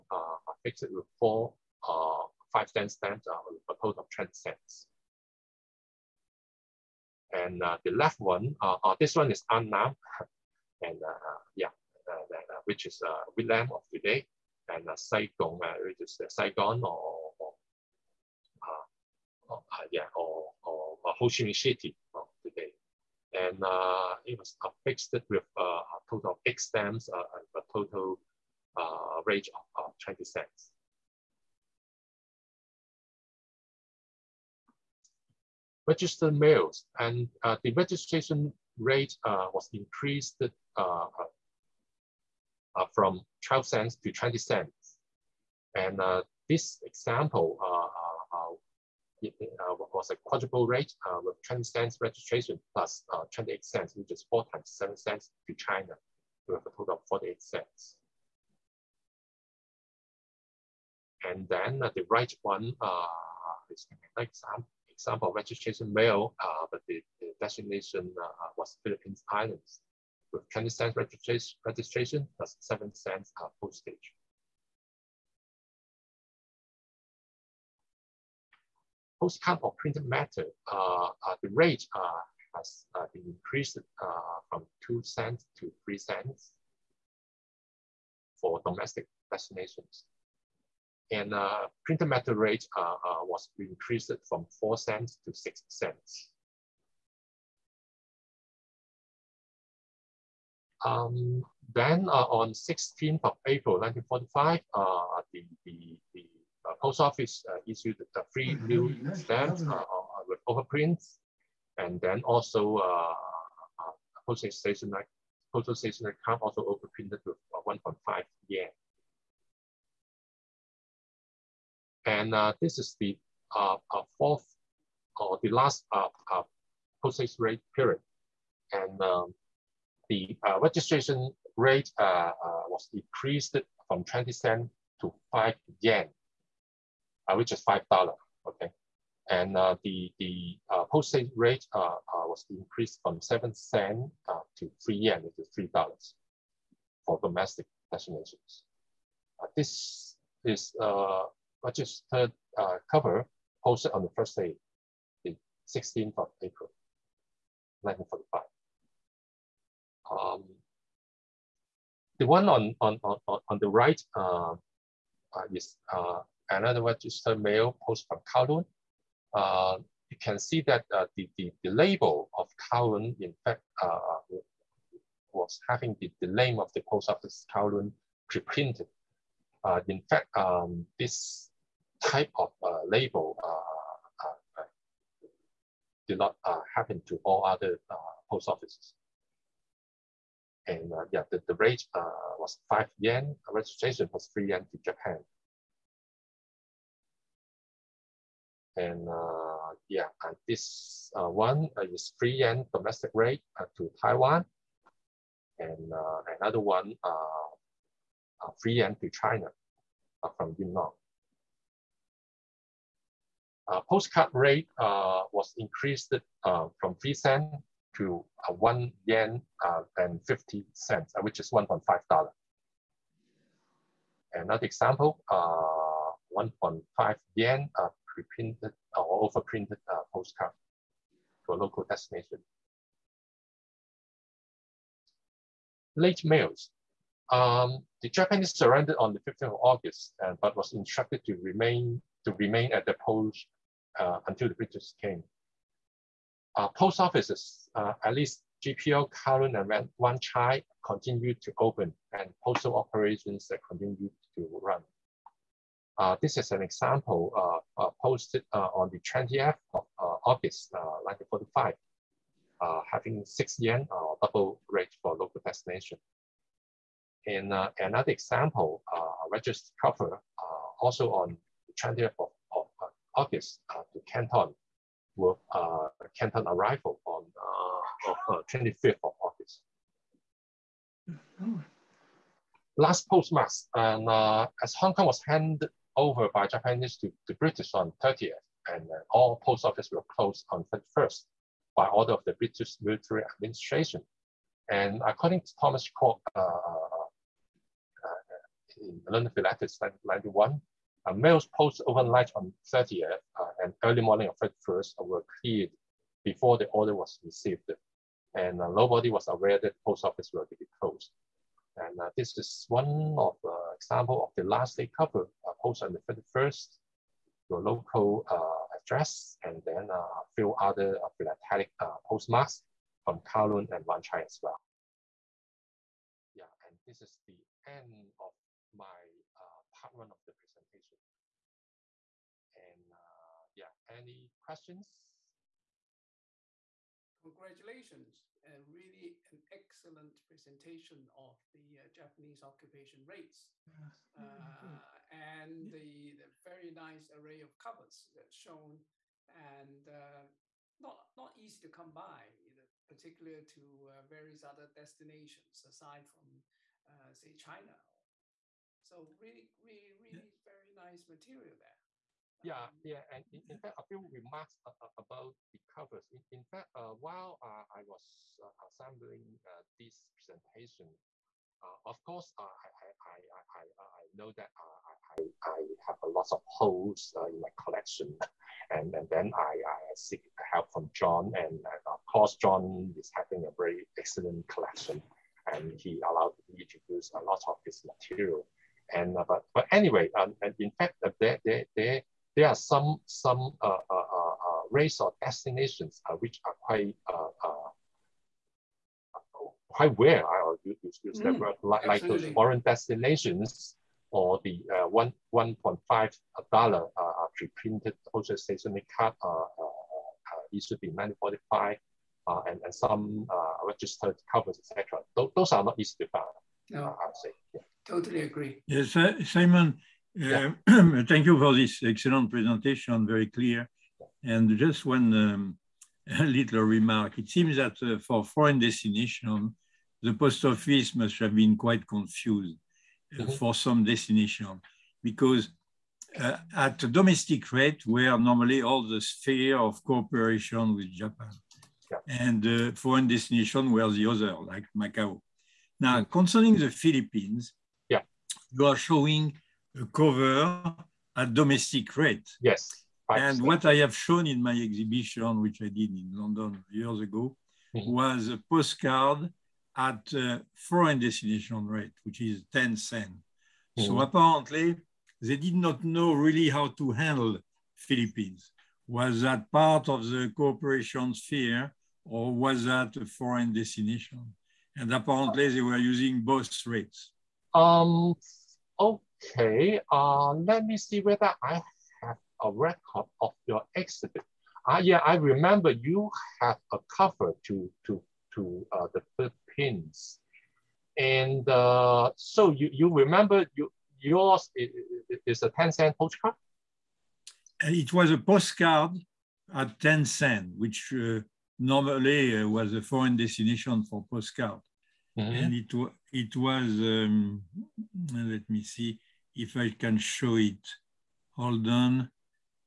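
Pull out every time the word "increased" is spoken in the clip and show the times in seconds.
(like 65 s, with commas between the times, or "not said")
39 s, 83 s, 93 s, 142 s, 215 s.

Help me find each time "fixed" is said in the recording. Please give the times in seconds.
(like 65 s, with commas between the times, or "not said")
0 s, 24 s.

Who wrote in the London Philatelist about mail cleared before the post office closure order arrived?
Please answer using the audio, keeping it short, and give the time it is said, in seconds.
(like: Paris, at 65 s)
Thomas Kwok, at 295 s.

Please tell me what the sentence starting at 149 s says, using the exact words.
this is registered cover posted on the first day, the 16th of April, 1945.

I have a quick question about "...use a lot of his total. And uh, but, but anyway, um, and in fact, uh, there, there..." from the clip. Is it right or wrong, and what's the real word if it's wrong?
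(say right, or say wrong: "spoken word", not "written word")
wrong: "material", not "total".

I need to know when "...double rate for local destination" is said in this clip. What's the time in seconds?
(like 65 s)
264 s.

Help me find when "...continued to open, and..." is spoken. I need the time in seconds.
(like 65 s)
250 s.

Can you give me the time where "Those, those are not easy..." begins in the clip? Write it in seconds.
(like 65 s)
415 s.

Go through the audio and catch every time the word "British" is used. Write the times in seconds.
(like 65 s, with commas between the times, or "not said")
244 s, 287 s, 292 s.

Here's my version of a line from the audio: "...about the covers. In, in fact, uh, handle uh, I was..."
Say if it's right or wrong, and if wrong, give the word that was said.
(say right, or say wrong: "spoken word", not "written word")
wrong: "while", not "handle".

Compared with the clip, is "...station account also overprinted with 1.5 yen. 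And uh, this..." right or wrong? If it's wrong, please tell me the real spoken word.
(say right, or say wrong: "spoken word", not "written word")
right.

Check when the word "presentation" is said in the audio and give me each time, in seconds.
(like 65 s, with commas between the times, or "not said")
330 s, 340 s, 370 s, 422 s.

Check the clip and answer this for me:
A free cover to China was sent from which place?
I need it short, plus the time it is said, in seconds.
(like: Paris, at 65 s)
Yunnan, at 210 s.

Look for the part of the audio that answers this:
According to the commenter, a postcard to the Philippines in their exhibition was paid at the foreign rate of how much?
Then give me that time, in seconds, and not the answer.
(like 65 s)
462 s.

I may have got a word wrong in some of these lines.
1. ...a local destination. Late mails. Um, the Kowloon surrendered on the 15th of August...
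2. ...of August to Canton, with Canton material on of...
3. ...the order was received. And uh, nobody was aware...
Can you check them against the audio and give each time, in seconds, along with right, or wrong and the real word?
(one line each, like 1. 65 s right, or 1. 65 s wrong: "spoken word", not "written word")
1. 231 s wrong: "Japanese", not "Kowloon"
2. 272 s wrong: "arrival", not "material"
3. 306 s right.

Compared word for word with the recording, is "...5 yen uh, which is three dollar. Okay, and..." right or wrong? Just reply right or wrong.
wrong.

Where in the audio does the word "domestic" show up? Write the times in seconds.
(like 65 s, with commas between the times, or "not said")
88 s, 147 s, 202 s, 436 s, 451 s.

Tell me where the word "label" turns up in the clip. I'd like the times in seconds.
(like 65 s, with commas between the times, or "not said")
171 s, 182 s.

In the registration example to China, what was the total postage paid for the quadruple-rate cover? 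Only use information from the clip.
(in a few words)
48 cents.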